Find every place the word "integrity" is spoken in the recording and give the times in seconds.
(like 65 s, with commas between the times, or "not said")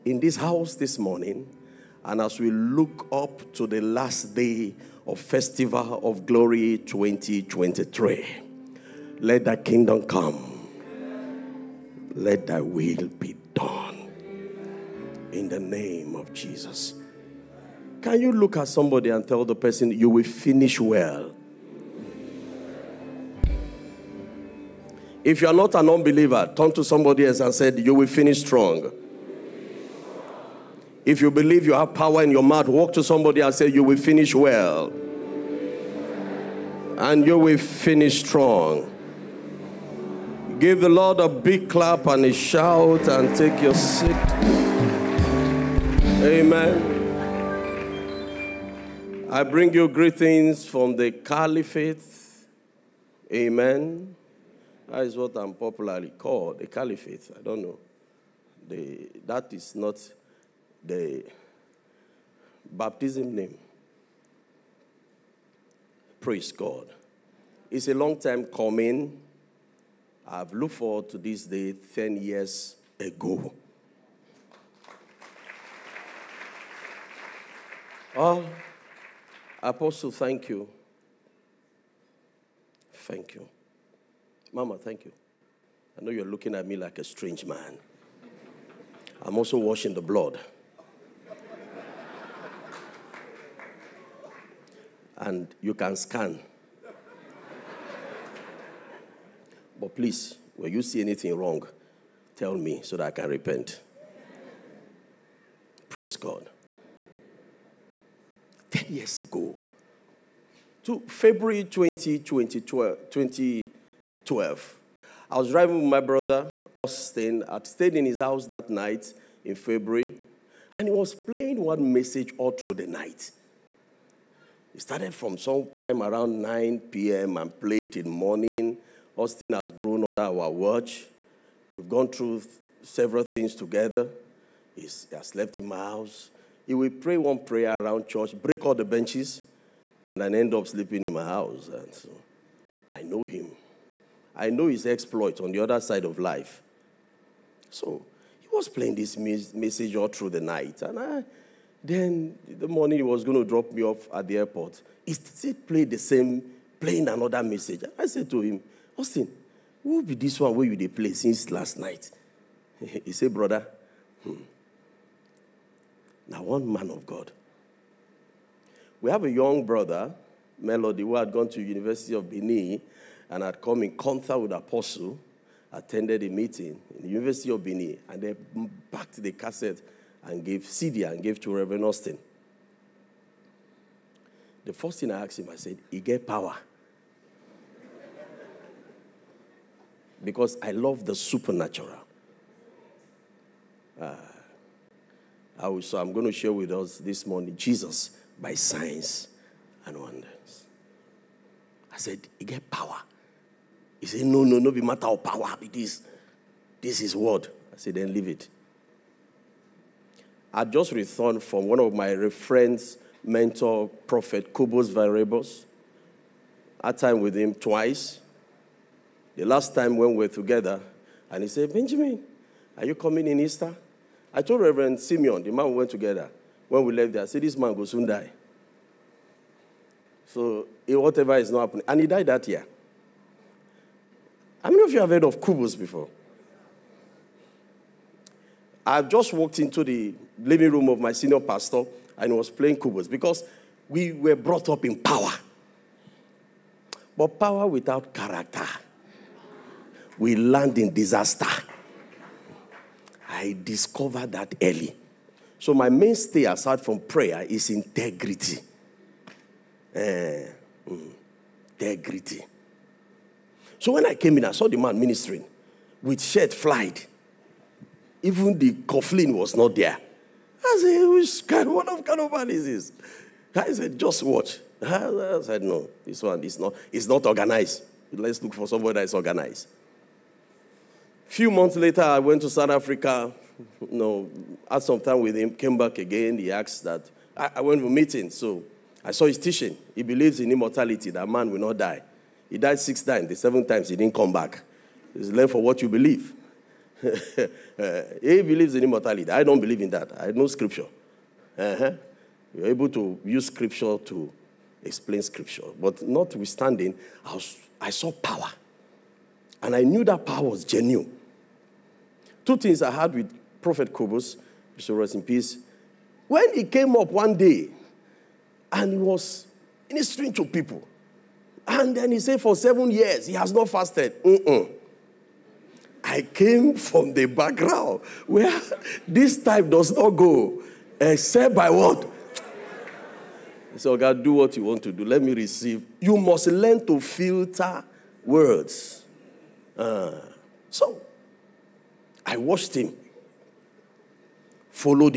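257 s, 261 s.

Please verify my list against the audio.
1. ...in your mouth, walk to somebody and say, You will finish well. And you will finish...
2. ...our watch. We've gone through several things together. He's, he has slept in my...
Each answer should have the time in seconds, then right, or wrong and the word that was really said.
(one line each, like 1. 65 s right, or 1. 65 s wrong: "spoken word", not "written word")
1. 32 s right
2. 130 s right.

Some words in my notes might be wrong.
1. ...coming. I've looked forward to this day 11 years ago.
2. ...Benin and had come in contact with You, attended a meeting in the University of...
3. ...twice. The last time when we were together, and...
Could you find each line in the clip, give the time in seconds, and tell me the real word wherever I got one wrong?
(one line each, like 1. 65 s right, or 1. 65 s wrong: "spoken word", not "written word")
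1. 68 s wrong: "10", not "11"
2. 172 s wrong: "Apostle", not "You"
3. 217 s right.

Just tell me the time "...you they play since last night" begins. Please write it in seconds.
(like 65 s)
160 s.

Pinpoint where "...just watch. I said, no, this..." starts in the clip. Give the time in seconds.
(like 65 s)
273 s.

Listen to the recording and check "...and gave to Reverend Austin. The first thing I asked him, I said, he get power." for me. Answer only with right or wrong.
right.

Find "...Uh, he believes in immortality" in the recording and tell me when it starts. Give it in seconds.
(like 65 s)
297 s.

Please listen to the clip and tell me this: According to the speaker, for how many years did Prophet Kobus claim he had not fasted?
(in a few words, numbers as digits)
7.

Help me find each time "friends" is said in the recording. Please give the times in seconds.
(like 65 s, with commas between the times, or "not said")
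212 s.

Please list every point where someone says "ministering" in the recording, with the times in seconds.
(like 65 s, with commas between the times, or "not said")
264 s, 319 s.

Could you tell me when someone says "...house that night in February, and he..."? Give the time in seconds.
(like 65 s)
118 s.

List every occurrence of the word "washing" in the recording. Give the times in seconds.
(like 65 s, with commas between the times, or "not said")
89 s.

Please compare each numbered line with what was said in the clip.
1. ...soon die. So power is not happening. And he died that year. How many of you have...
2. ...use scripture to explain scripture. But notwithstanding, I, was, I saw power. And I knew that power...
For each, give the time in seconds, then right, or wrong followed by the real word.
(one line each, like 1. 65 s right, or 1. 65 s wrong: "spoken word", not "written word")
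1. 227 s wrong: "whatever", not "power"
2. 303 s right.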